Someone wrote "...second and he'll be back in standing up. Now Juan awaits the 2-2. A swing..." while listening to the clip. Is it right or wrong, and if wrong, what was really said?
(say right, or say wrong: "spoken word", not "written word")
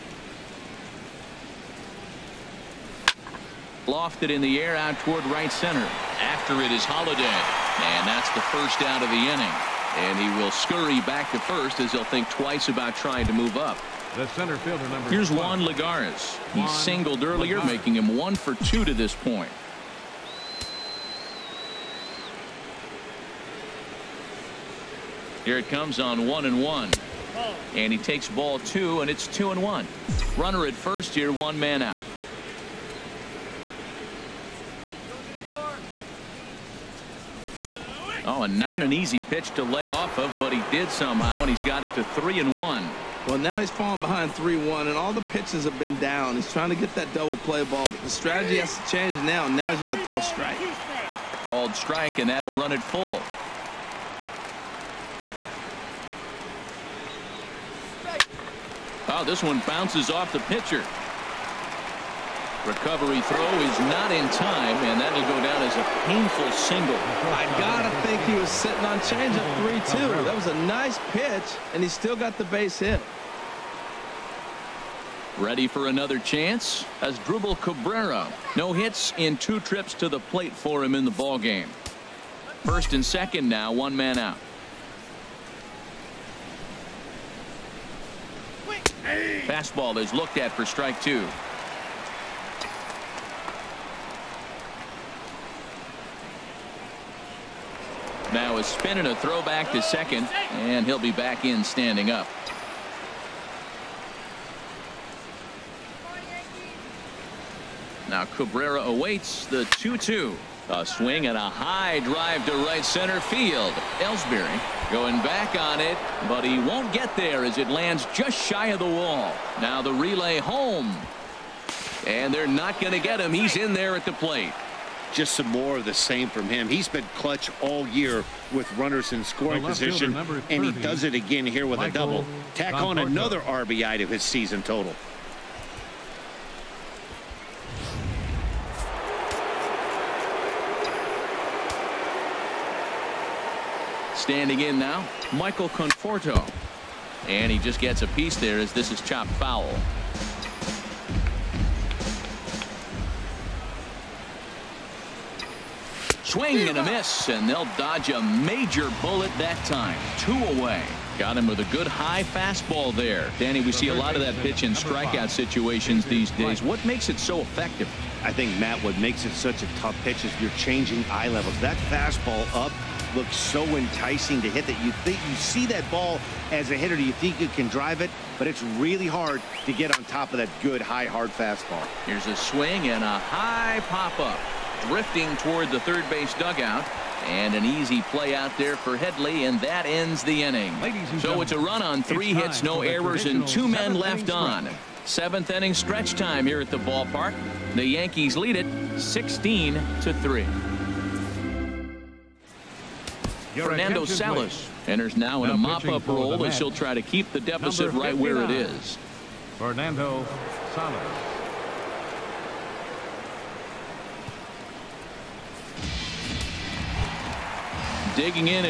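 wrong: "Cabrera", not "Juan".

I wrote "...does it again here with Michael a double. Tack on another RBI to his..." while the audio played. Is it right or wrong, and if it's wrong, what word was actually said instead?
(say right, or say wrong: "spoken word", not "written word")
right.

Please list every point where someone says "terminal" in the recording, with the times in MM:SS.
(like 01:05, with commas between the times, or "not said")
not said.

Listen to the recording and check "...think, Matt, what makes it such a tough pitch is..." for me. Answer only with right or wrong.
right.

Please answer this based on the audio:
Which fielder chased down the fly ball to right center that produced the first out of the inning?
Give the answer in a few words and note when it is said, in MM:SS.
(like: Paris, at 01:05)
Holliday, at 00:06.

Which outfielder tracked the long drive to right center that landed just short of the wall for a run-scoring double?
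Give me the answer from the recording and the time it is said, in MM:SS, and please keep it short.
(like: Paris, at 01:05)
Ellsbury, at 01:54.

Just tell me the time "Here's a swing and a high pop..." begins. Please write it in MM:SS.
03:02.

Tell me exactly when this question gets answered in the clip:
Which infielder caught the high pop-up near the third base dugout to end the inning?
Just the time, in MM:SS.
03:08.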